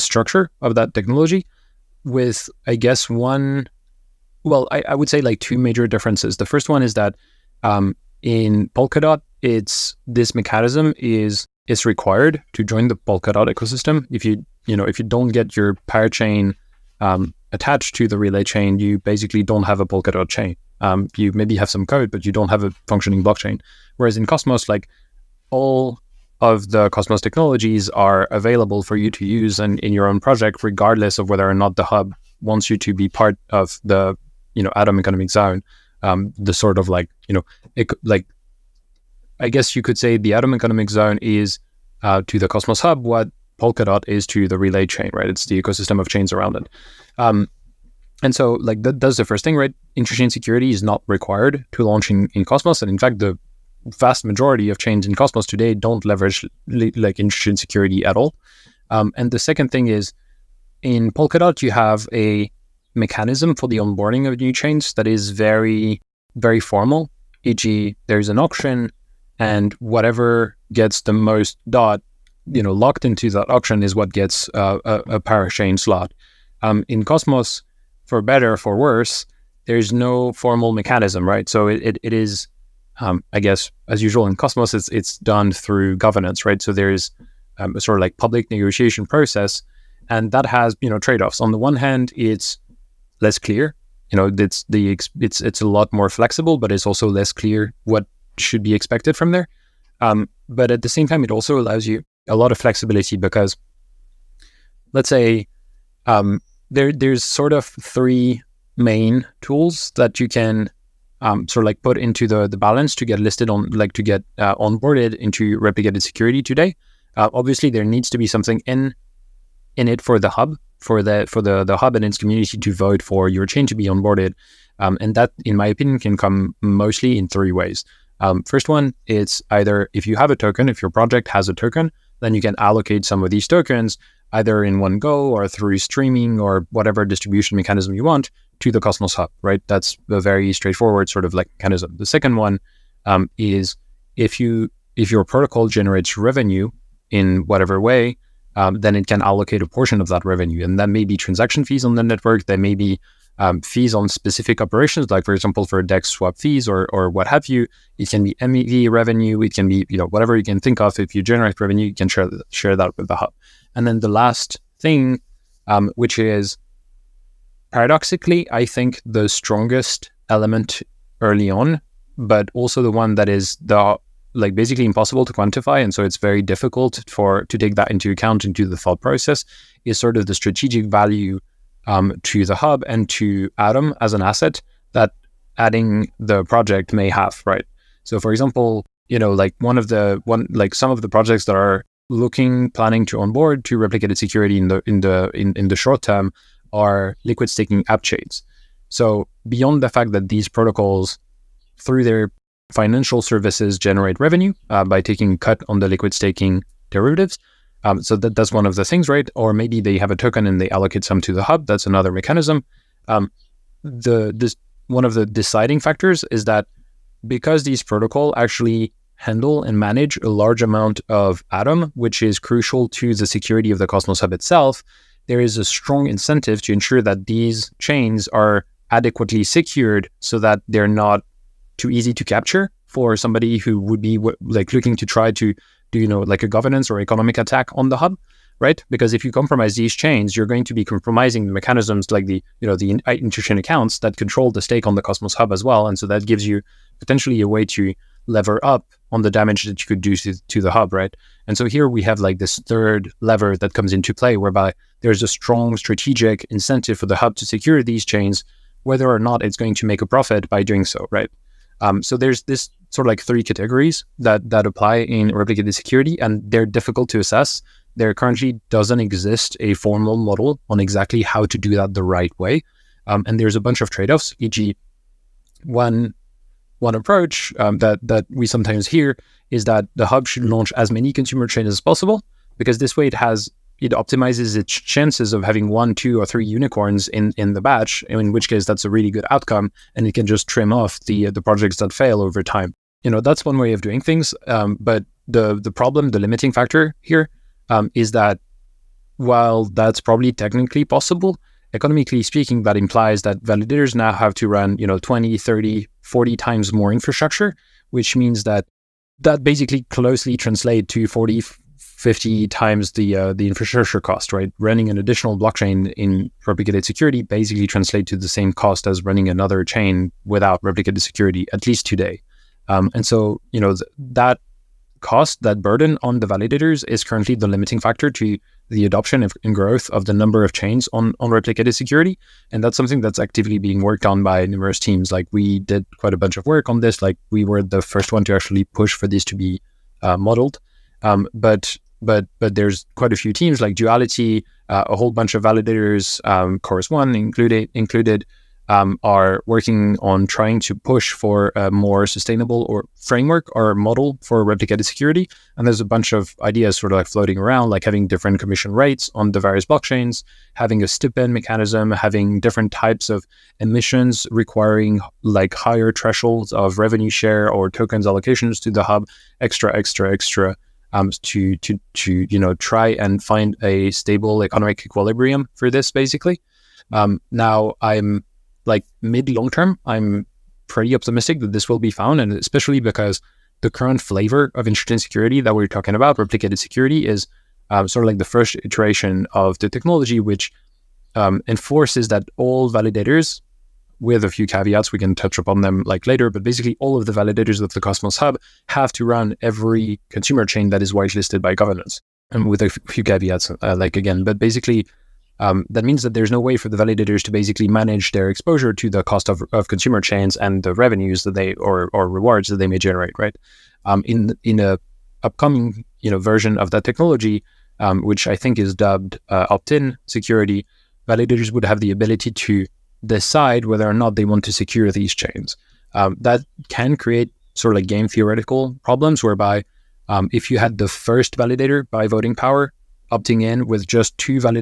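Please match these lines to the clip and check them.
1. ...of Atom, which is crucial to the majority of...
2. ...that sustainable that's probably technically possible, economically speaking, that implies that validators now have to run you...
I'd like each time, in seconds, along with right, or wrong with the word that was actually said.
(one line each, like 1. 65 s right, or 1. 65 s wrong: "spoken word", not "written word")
1. 221 s wrong: "security", not "majority"
2. 298 s wrong: "while", not "sustainable".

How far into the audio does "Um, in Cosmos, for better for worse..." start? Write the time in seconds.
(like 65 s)
76 s.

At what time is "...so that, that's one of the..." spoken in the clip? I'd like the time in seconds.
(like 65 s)
208 s.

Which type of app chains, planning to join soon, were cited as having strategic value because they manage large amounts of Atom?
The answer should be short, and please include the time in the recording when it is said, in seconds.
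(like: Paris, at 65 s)
Liquid staking app chains, at 197 s.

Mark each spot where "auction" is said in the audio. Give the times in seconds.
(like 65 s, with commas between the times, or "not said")
68 s, 73 s.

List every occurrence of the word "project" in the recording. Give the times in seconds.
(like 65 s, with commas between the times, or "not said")
30 s, 130 s, 186 s, 191 s, 291 s.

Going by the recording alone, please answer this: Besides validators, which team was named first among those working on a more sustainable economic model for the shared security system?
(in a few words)
Duality.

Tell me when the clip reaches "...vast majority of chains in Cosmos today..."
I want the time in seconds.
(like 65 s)
53 s.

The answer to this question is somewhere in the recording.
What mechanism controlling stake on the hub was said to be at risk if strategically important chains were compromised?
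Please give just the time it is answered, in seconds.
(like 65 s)
243 s.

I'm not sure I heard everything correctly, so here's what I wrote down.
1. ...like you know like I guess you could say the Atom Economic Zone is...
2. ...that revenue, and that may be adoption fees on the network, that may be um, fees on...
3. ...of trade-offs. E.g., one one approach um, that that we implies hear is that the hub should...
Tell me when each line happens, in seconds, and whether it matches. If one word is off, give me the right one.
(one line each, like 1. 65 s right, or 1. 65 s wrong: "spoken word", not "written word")
1. 36 s right
2. 150 s wrong: "transaction", not "adoption"
3. 273 s wrong: "sometimes", not "implies".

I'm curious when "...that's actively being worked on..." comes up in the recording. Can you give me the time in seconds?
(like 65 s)
333 s.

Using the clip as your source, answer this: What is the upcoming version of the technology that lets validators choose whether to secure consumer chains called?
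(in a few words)
Opt-in security.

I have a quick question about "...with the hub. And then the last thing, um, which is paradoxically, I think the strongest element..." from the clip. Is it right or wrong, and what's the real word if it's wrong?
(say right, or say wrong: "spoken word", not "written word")
right.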